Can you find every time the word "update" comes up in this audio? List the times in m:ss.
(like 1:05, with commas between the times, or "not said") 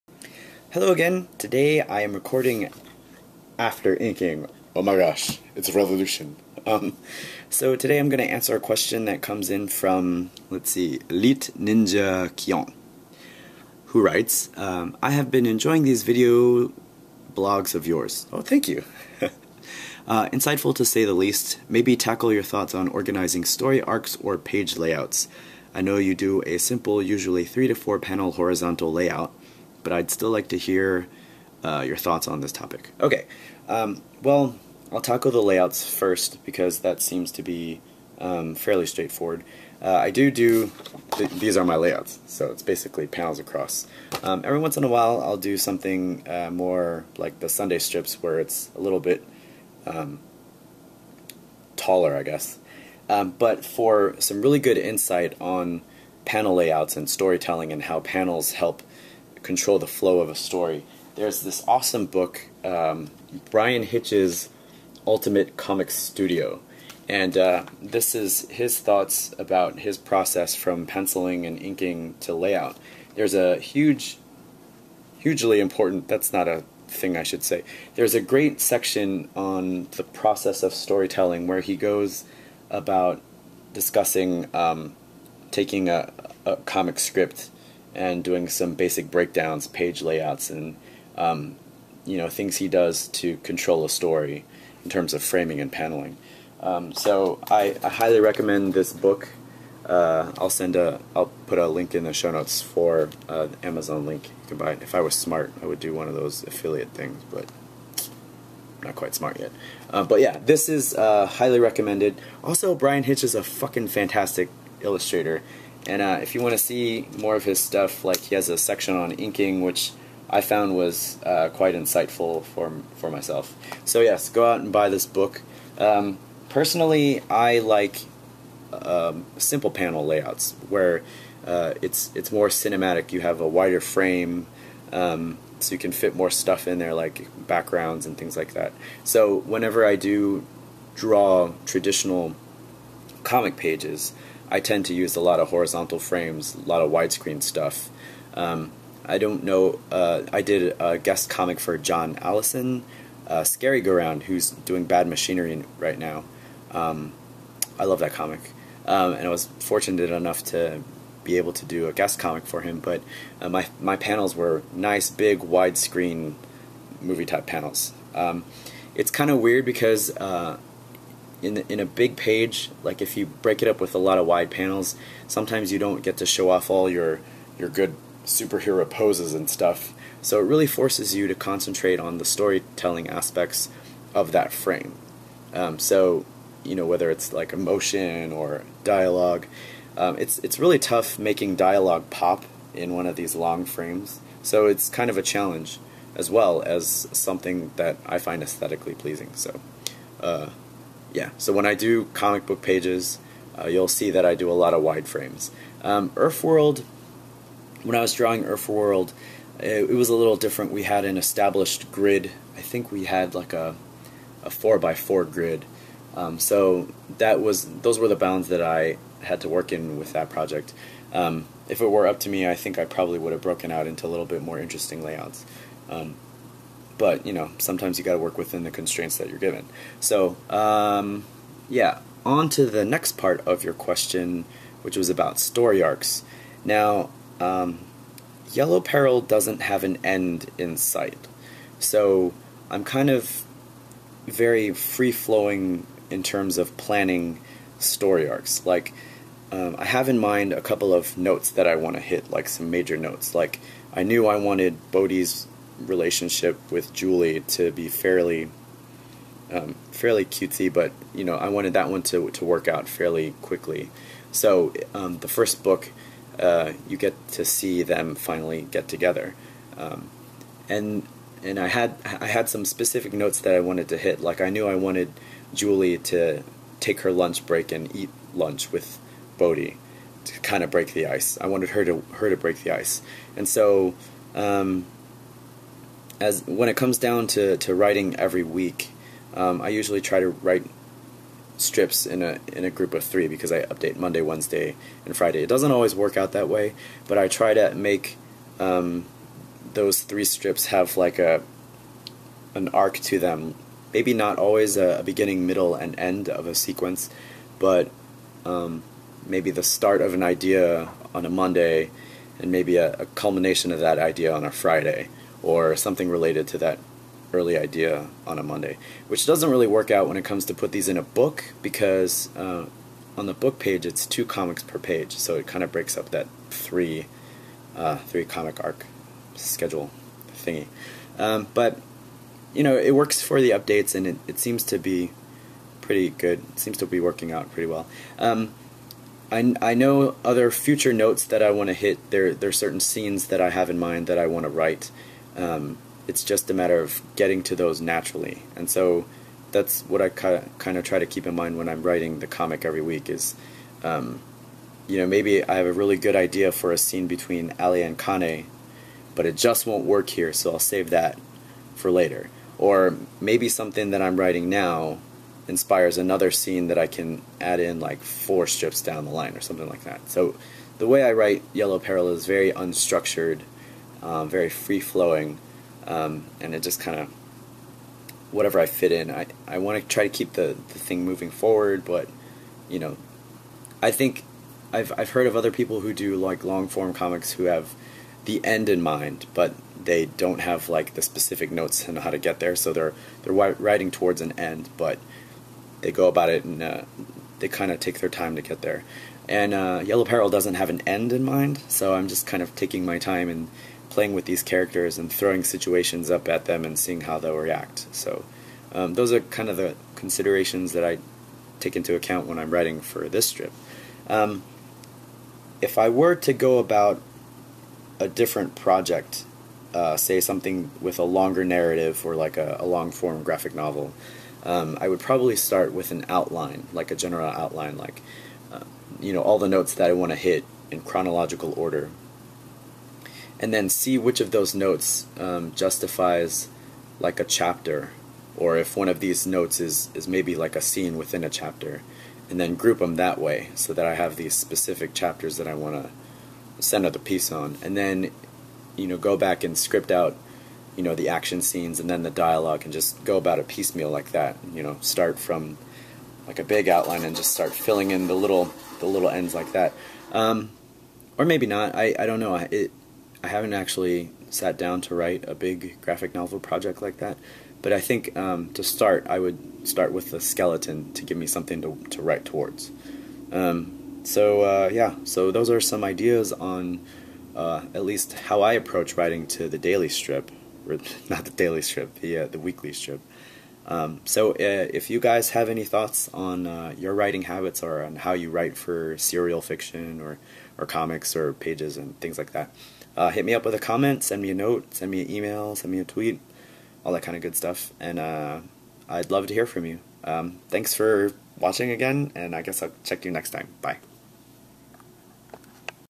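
4:53, 5:33.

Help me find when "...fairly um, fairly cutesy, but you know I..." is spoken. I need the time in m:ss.
4:17.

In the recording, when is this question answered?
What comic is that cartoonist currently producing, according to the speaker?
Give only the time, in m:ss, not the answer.
2:34.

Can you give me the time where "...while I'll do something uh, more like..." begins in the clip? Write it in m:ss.
0:44.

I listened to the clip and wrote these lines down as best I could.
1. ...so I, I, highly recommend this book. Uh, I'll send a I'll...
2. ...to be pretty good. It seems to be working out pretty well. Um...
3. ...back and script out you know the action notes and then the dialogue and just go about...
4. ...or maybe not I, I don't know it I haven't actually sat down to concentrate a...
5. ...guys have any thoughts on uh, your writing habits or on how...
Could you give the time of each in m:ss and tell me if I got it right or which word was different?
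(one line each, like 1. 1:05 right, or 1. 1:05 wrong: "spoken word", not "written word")
1. 1:36 right
2. 5:34 right
3. 7:29 wrong: "scenes", not "notes"
4. 7:41 wrong: "write", not "concentrate"
5. 8:04 right.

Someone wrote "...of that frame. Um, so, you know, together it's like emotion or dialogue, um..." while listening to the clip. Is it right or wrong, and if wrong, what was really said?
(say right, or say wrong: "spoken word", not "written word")
wrong: "whether", not "together".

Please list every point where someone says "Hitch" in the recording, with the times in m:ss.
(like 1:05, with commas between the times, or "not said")
1:03, 1:53.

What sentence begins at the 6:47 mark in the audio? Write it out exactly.
So um, those are kind of the considerations that I take into account when I'm writing for this strip.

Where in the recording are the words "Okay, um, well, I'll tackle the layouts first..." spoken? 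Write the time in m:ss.
0:32.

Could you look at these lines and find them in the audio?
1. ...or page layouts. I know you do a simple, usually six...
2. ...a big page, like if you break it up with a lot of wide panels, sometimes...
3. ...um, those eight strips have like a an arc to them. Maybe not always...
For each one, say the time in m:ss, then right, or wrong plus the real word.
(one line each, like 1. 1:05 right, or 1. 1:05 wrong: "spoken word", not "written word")
1. 0:24 wrong: "three", not "six"
2. 2:51 right
3. 4:58 wrong: "three", not "eight".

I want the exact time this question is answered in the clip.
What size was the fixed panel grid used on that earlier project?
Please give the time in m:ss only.
3:34.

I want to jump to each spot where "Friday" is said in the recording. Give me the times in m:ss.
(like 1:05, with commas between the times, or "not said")
4:55, 5:14.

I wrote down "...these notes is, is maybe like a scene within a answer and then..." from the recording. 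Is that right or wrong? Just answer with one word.
wrong.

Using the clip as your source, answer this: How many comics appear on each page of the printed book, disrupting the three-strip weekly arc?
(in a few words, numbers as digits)
2.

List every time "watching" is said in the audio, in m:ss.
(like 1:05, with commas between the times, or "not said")
8:21.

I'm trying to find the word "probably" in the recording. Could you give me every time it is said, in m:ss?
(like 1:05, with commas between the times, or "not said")
3:42, 7:04.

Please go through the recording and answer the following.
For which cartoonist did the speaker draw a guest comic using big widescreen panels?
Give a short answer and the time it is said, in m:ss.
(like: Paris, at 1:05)
John Allison, at 2:31.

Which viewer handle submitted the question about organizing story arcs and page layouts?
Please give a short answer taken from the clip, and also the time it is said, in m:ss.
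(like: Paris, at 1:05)
Elite Ninja Kion, at 0:11.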